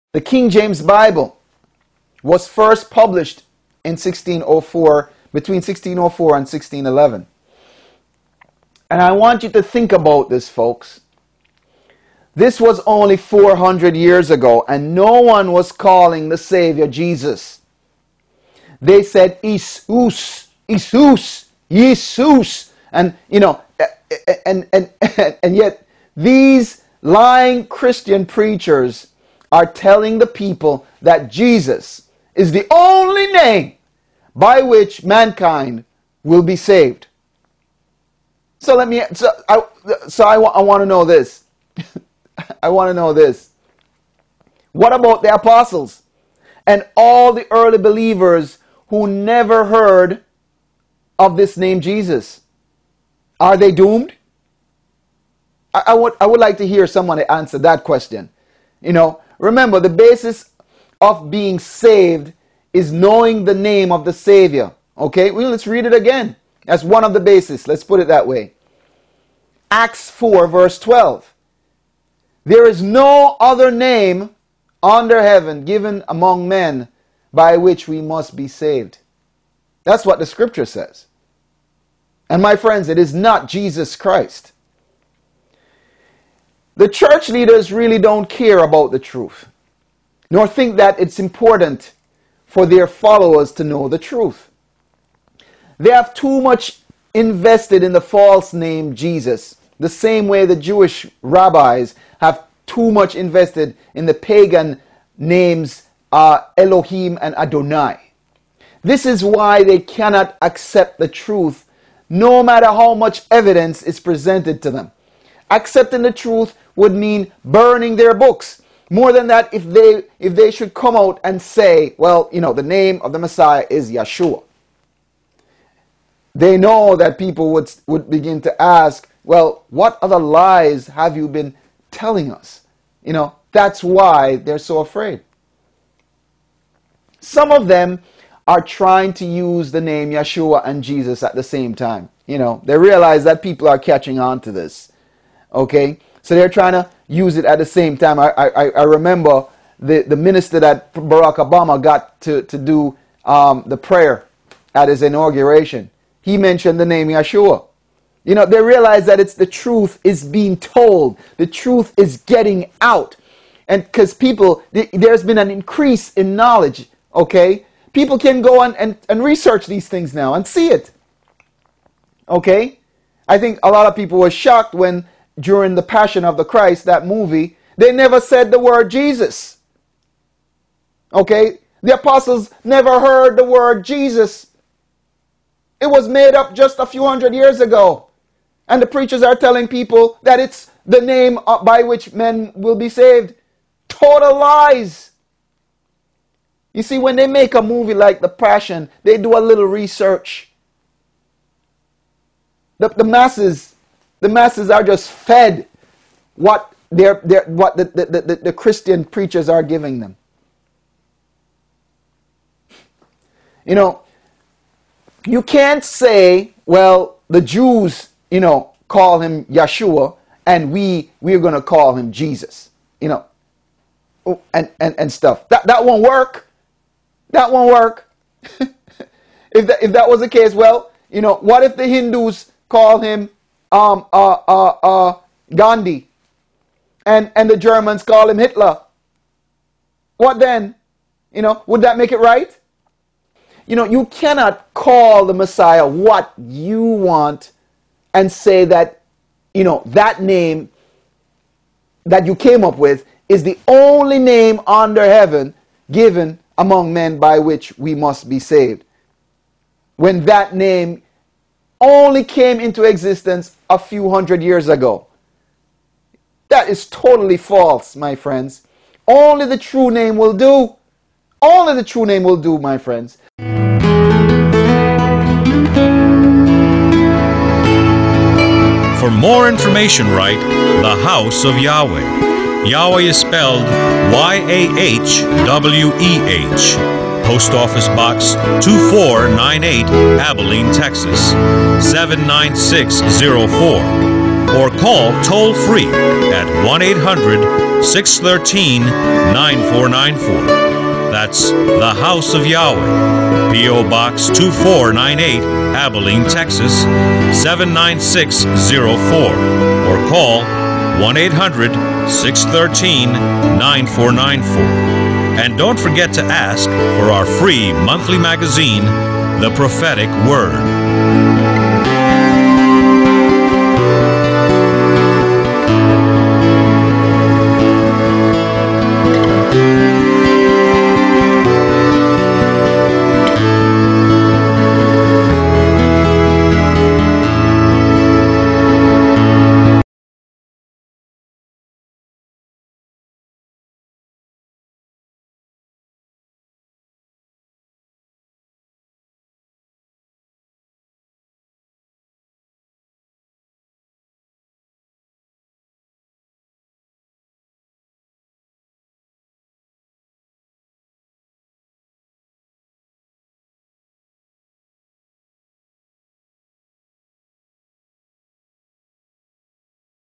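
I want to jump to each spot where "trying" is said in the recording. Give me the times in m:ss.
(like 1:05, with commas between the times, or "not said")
2:18, 2:26.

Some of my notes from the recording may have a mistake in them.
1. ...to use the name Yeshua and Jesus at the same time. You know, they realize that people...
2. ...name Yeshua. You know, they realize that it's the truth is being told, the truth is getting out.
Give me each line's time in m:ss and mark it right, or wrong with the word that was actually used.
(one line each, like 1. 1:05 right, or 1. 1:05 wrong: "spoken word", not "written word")
1. 2:19 right
2. 2:36 right.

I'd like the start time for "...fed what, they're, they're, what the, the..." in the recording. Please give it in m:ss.
3:25.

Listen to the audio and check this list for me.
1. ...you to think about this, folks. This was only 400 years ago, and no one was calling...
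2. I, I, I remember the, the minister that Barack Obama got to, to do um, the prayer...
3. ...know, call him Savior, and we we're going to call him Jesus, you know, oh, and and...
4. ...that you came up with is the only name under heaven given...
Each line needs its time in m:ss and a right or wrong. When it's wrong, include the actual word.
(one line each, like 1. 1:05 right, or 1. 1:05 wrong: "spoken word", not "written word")
1. 0:09 right
2. 2:28 right
3. 3:38 wrong: "Yeshua", not "Savior"
4. 4:12 right.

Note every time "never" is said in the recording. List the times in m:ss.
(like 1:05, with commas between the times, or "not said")
0:49, 2:57, 3:02.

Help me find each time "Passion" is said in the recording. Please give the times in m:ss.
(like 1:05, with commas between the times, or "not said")
2:55, 3:18.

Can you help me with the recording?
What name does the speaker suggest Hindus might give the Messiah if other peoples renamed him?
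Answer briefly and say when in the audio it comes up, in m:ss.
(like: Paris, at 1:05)
Gandhi, at 3:55.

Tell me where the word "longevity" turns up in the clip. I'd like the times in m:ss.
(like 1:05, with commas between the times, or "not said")
not said.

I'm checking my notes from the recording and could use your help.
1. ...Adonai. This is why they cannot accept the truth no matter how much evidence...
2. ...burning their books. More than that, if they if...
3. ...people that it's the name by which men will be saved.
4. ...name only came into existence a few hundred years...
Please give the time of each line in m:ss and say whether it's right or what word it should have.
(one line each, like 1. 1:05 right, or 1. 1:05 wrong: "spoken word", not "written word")
1. 1:47 right
2. 1:57 right
3. 3:09 right
4. 4:20 right.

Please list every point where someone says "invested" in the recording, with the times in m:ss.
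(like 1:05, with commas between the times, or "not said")
1:37, 1:43.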